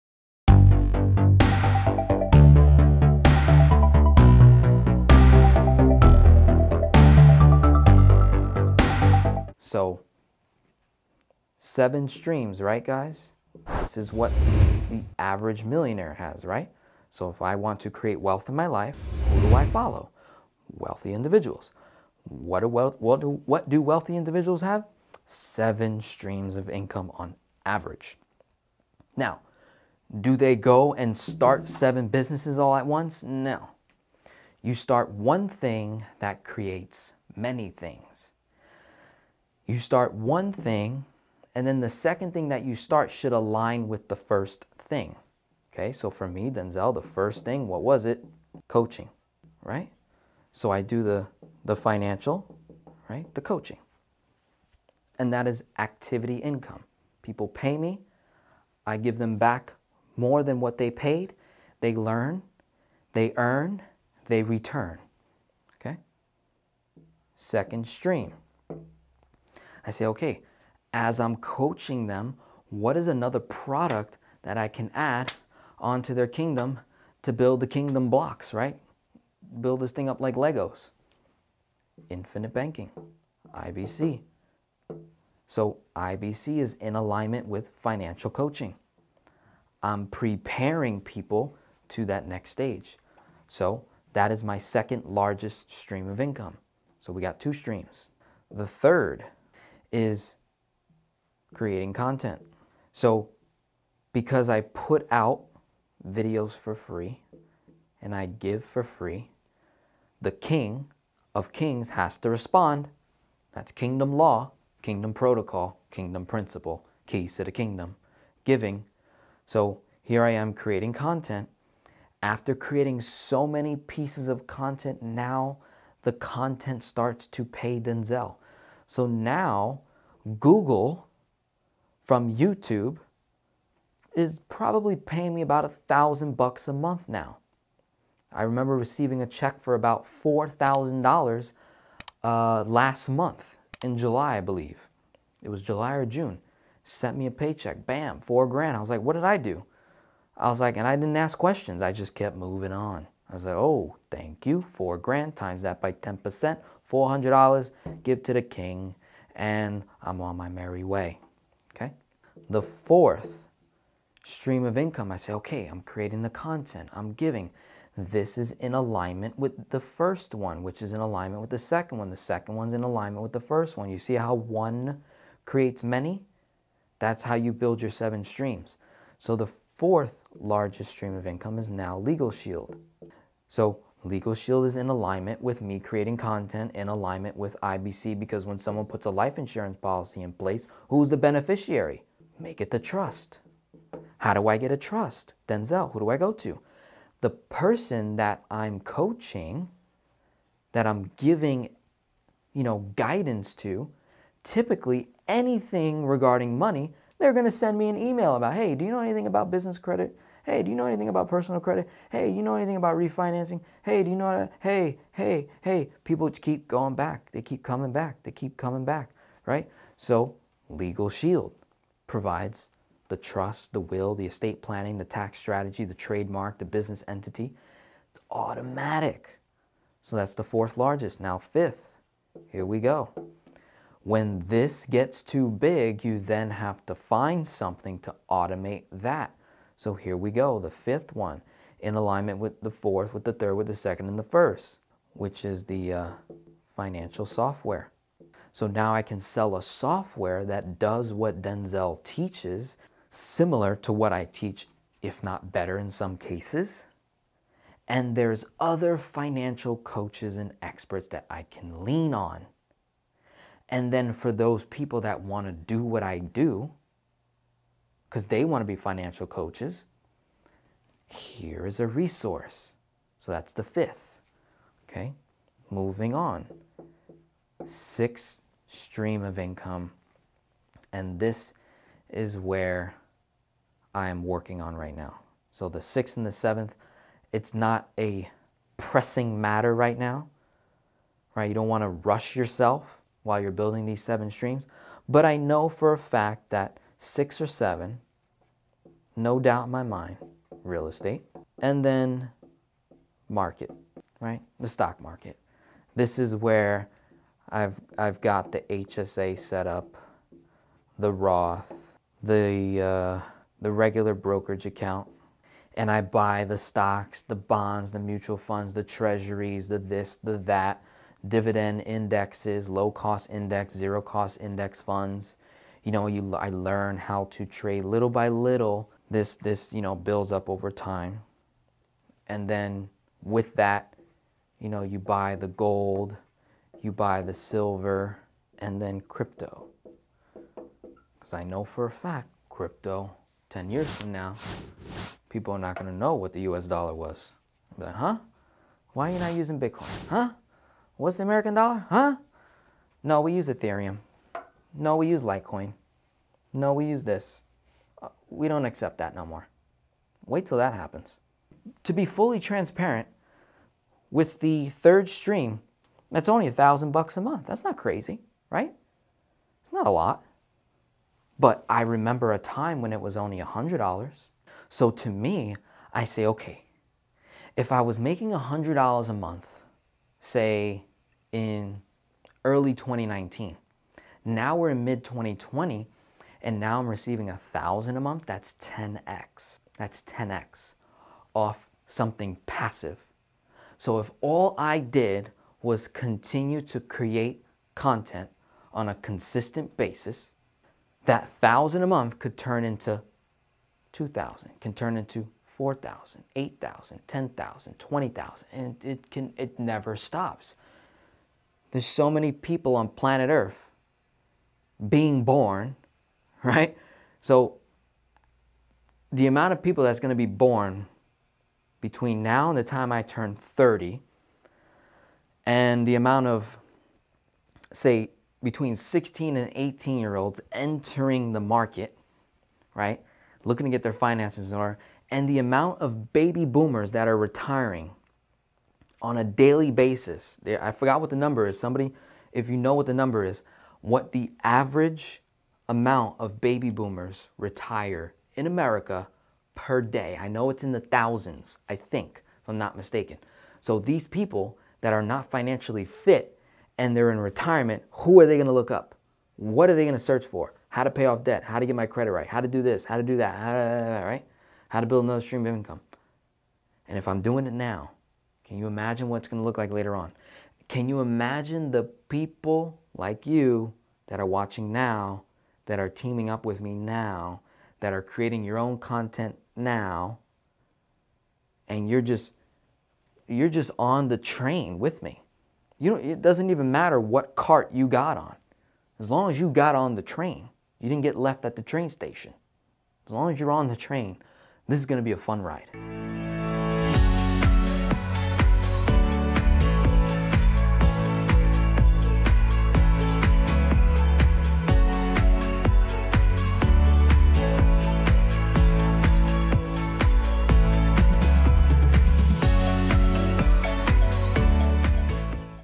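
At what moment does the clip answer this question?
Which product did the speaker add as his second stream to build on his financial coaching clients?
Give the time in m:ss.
1:22.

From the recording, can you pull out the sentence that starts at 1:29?
I'm preparing people to that next stage.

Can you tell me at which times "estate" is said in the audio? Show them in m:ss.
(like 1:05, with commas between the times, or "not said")
3:44, 5:00.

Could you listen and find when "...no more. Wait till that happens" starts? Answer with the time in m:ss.
5:59.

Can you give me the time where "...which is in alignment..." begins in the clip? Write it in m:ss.
2:50.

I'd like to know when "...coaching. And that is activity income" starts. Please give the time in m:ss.
0:53.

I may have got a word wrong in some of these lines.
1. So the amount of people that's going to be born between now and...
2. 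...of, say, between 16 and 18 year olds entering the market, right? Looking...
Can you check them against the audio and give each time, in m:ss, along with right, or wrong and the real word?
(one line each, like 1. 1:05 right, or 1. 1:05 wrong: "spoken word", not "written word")
1. 6:57 right
2. 7:06 right.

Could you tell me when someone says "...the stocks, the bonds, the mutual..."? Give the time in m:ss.
5:16.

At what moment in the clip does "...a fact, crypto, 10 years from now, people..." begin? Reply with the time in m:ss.
5:41.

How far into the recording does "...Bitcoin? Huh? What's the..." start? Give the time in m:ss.
5:49.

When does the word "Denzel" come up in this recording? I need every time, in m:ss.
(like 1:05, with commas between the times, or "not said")
0:46, 2:07, 3:15, 4:11.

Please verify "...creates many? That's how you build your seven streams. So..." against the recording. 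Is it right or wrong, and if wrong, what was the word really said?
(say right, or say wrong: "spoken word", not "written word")
right.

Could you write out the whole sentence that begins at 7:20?
I forgot what the number is.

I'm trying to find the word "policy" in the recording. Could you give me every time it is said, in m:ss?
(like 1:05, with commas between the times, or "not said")
3:09.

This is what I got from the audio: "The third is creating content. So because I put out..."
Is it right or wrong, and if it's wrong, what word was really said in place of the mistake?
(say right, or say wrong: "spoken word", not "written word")
right.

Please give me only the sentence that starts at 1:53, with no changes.
That's kingdom law, kingdom protocol, kingdom principle, keys to the kingdom, giving.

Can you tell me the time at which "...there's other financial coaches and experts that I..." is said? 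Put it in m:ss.
4:18.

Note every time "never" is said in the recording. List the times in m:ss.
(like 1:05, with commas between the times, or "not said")
6:49.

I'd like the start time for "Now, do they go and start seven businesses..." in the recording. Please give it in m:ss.
0:29.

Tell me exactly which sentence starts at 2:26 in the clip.
Sent me a paycheck, bam, four grand.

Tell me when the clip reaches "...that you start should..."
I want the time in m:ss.
0:42.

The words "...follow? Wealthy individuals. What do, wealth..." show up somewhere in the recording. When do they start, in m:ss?
0:19.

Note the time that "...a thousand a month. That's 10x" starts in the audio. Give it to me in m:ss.
6:27.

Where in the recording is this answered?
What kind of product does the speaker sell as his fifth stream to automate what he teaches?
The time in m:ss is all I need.
4:06.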